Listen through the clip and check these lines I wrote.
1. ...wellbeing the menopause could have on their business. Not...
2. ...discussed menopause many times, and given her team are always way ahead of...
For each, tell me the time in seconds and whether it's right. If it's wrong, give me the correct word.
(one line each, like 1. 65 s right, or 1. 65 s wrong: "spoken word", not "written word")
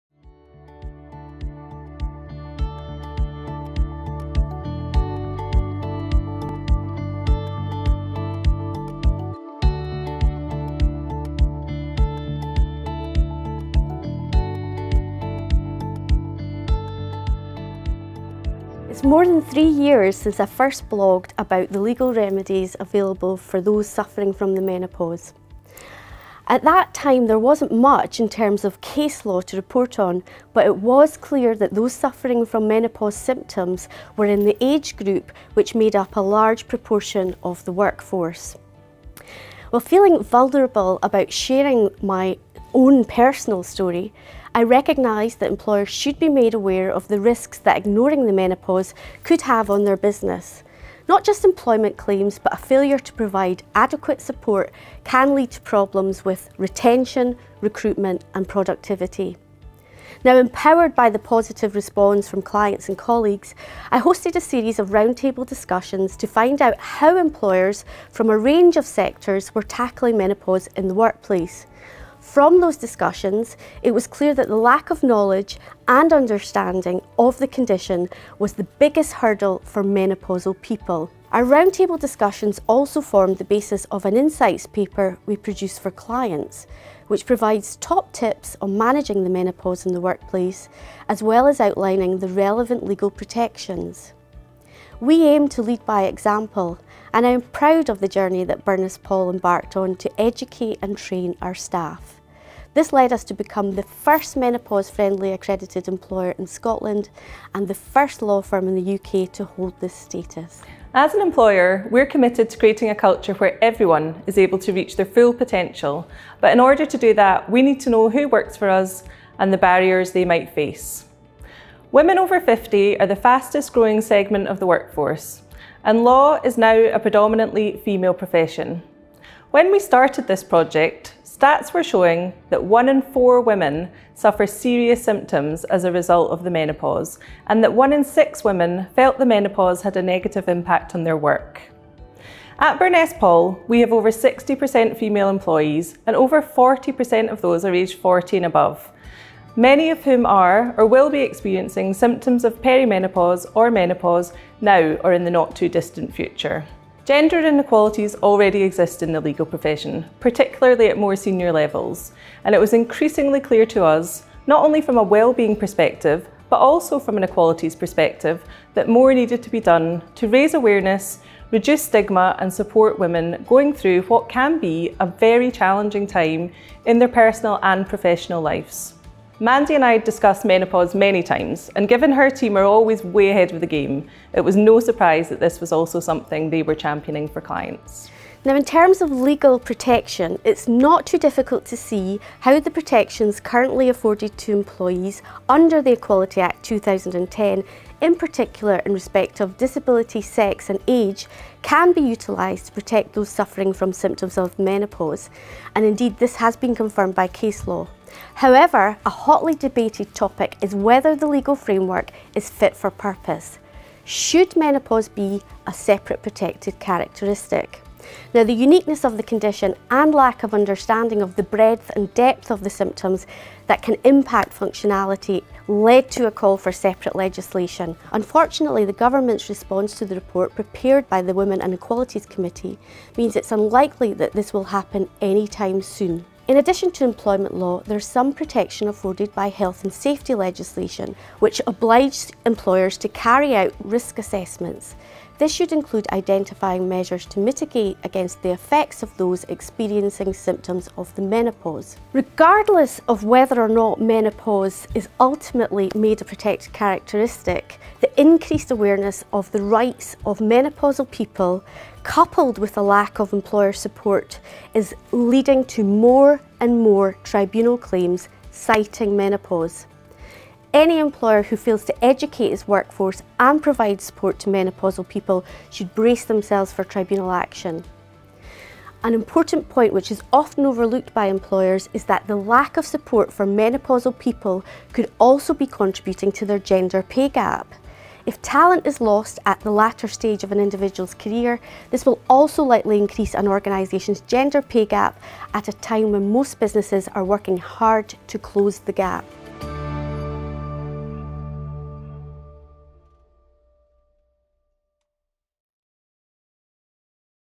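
1. 47 s wrong: "ignoring", not "wellbeing"
2. 180 s right.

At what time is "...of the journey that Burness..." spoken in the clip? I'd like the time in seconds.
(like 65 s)
97 s.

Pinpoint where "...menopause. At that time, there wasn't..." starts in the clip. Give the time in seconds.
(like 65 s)
24 s.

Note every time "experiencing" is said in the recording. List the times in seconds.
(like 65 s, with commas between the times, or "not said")
151 s, 249 s.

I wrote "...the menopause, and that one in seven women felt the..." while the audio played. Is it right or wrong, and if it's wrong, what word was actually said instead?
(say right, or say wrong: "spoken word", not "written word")
wrong: "six", not "seven".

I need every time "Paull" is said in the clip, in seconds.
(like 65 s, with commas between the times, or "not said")
99 s, 143 s.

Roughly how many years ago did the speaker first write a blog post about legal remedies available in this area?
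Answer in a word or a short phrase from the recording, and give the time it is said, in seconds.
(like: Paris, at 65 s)
more than 3 years, at 19 s.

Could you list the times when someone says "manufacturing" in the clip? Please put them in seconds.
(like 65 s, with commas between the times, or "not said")
not said.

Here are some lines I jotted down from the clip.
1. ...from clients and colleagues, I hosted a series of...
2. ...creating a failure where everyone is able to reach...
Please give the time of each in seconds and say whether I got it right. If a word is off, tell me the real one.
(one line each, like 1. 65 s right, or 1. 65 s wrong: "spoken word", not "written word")
1. 62 s right
2. 112 s wrong: "culture", not "failure".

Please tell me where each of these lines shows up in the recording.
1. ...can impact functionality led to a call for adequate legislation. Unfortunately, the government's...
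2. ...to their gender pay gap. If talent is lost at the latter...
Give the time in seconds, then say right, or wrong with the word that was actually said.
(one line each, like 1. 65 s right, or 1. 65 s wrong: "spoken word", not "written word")
1. 223 s wrong: "separate", not "adequate"
2. 286 s right.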